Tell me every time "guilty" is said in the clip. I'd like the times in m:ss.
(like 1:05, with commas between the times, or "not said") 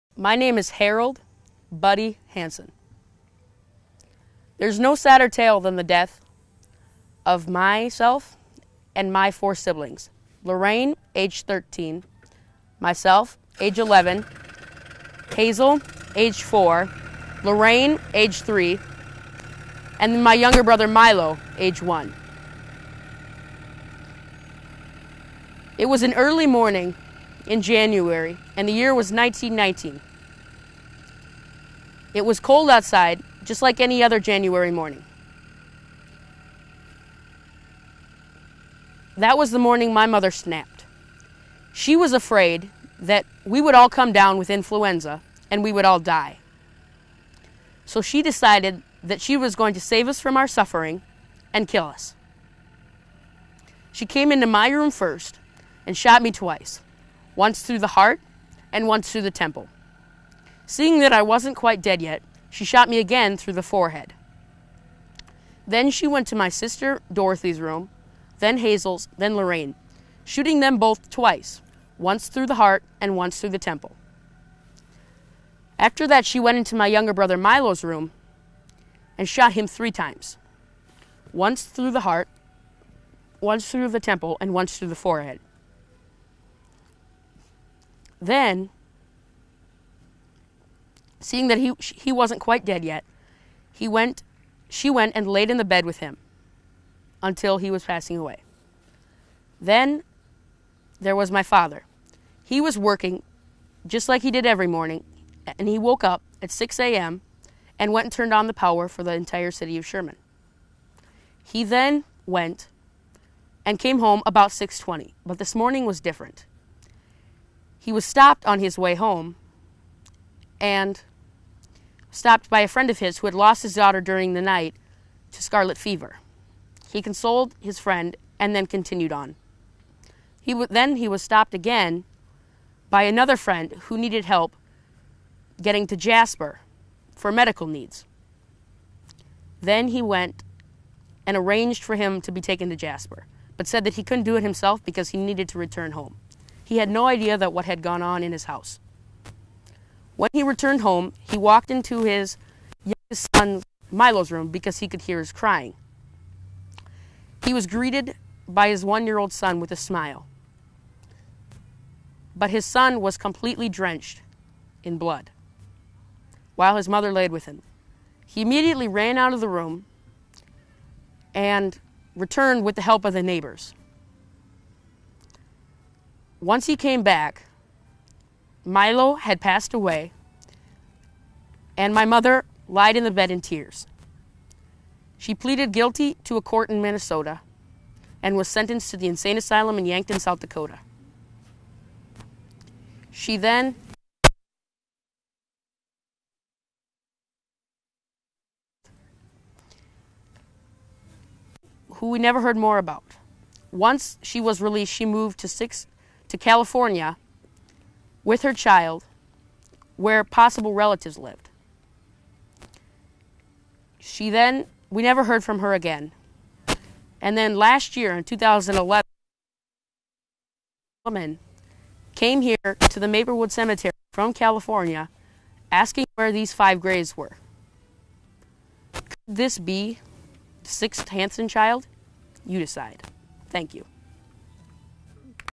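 3:05.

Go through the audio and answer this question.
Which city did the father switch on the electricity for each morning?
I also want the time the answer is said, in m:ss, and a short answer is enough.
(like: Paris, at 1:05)
Sherman, at 1:49.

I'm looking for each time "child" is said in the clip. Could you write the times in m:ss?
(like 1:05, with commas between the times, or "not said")
3:28, 3:51.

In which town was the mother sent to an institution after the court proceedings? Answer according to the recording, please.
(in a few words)
Yankton, South Dakota.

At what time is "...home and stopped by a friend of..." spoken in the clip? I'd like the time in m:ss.
1:58.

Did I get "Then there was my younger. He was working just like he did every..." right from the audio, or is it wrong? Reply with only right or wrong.
wrong.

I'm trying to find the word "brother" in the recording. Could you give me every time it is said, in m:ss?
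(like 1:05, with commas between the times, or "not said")
0:20, 1:17.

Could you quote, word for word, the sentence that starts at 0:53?
She came into my room first and shot me twice, once through the heart and once through the temple.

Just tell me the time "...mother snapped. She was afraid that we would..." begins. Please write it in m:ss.
0:40.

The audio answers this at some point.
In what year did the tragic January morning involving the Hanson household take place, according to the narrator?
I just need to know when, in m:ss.
0:29.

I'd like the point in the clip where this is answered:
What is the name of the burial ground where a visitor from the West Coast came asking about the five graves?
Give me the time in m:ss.
3:43.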